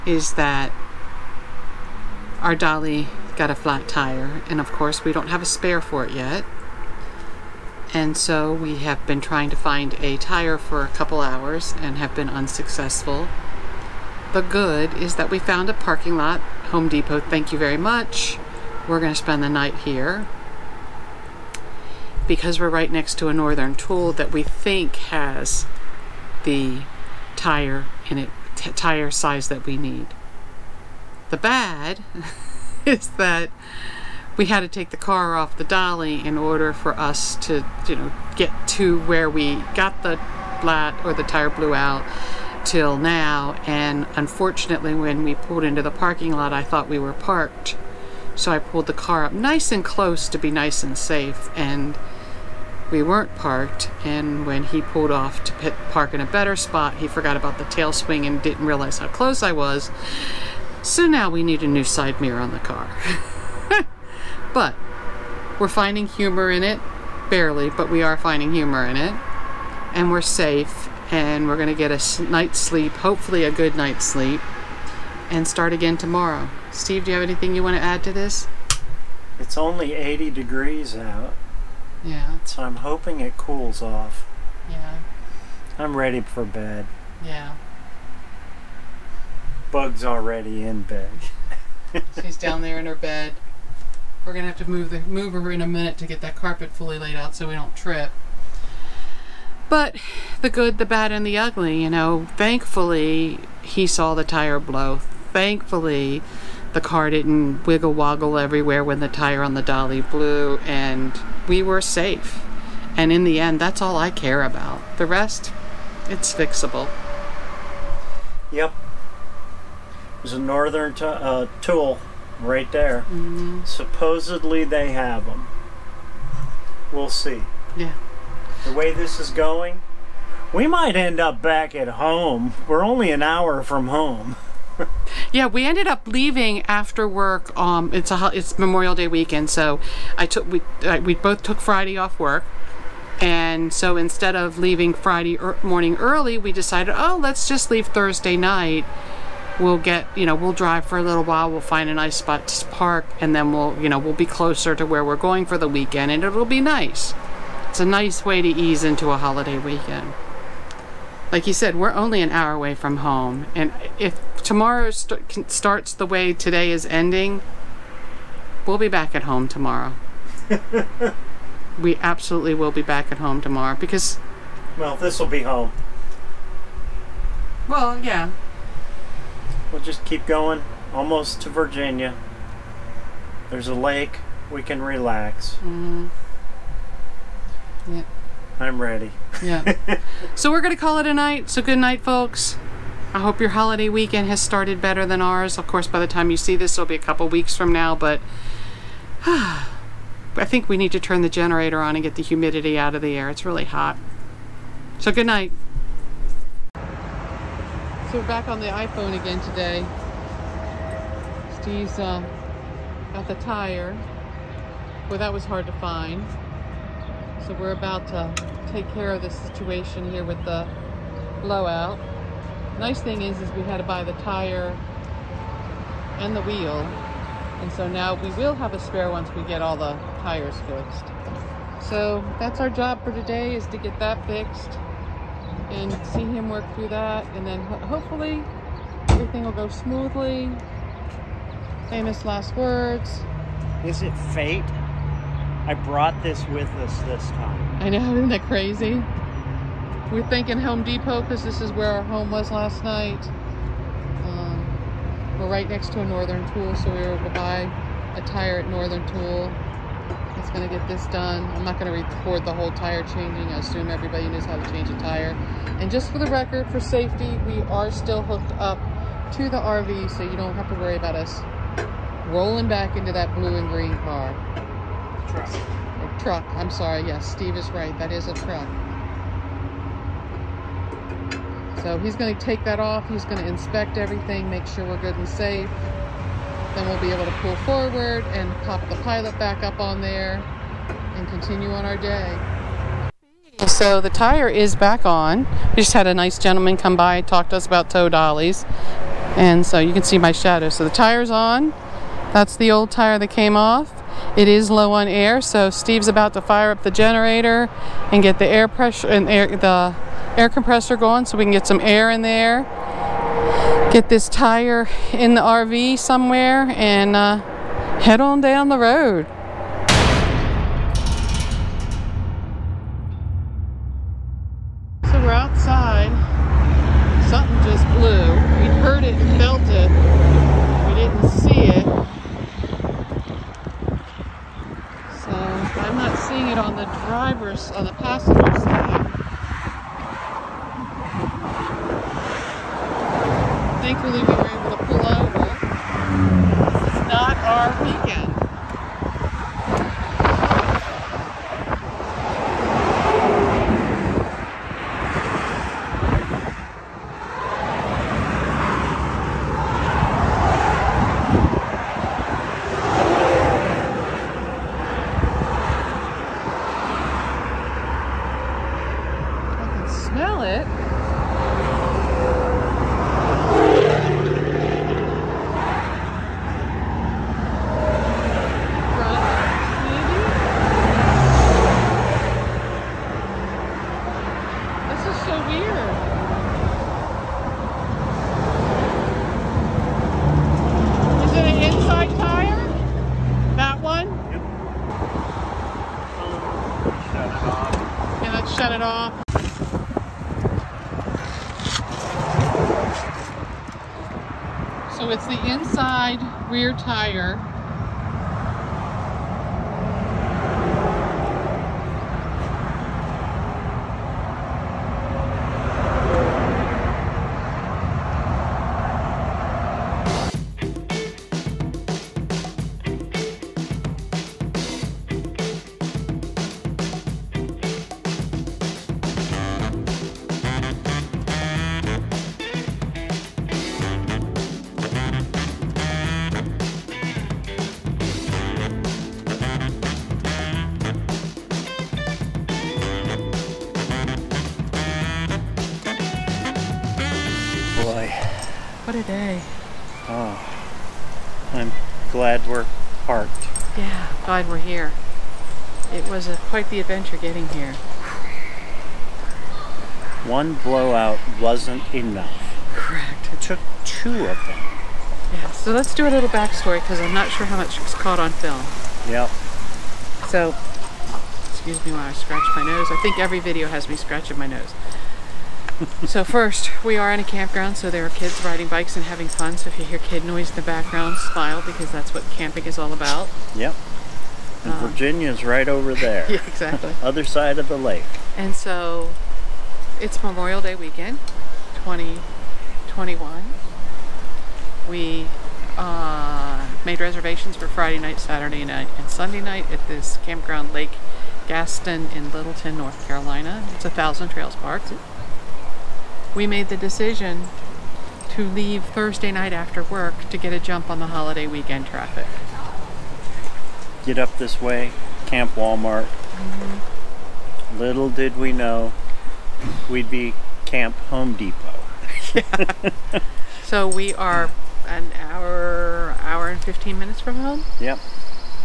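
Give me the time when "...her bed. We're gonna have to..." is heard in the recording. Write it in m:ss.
1:32.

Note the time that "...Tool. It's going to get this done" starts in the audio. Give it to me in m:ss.
4:19.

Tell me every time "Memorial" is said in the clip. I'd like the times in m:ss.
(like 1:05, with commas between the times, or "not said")
2:18, 8:10.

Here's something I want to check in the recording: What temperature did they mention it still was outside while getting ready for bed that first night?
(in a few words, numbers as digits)
80 degrees.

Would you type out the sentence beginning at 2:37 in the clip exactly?
It's a nice way to ease into a holiday weekend.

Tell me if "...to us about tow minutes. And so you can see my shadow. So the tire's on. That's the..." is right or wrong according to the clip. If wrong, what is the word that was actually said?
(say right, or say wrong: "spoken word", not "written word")
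wrong: "dollies", not "minutes".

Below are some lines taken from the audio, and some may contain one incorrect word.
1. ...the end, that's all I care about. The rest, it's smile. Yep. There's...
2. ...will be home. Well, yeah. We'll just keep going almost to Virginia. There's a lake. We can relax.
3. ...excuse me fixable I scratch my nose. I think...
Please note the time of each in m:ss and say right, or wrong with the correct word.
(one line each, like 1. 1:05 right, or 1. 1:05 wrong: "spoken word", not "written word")
1. 1:53 wrong: "fixable", not "smile"
2. 2:55 right
3. 7:51 wrong: "while", not "fixable".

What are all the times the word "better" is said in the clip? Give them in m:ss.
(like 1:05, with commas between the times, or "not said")
0:56, 3:14.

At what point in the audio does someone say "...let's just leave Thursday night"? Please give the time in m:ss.
2:27.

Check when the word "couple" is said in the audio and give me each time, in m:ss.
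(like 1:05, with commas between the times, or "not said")
0:10, 3:16.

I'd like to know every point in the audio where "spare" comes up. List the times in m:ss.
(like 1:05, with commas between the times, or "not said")
0:05, 3:48.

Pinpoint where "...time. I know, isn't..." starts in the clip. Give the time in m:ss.
4:07.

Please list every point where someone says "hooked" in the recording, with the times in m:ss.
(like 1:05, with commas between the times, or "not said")
4:28.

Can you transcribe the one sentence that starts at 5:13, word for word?
Get this tire in the RV somewhere and uh, head on down the road.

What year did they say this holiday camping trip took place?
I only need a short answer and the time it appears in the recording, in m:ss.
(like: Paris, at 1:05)
2021, at 8:11.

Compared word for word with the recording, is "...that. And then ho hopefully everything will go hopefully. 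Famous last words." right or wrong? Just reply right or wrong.
wrong.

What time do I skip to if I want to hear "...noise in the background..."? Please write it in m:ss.
8:00.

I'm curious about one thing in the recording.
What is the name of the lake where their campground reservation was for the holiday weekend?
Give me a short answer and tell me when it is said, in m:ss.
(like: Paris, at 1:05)
Lake Gaston, at 8:20.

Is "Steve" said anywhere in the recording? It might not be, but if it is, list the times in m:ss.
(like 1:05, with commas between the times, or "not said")
1:16, 3:31, 4:37, 5:05.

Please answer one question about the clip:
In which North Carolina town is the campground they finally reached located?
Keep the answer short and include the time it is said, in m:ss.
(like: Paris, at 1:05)
Littleton, at 8:22.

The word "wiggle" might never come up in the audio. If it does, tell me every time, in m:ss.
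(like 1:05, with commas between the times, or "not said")
1:47.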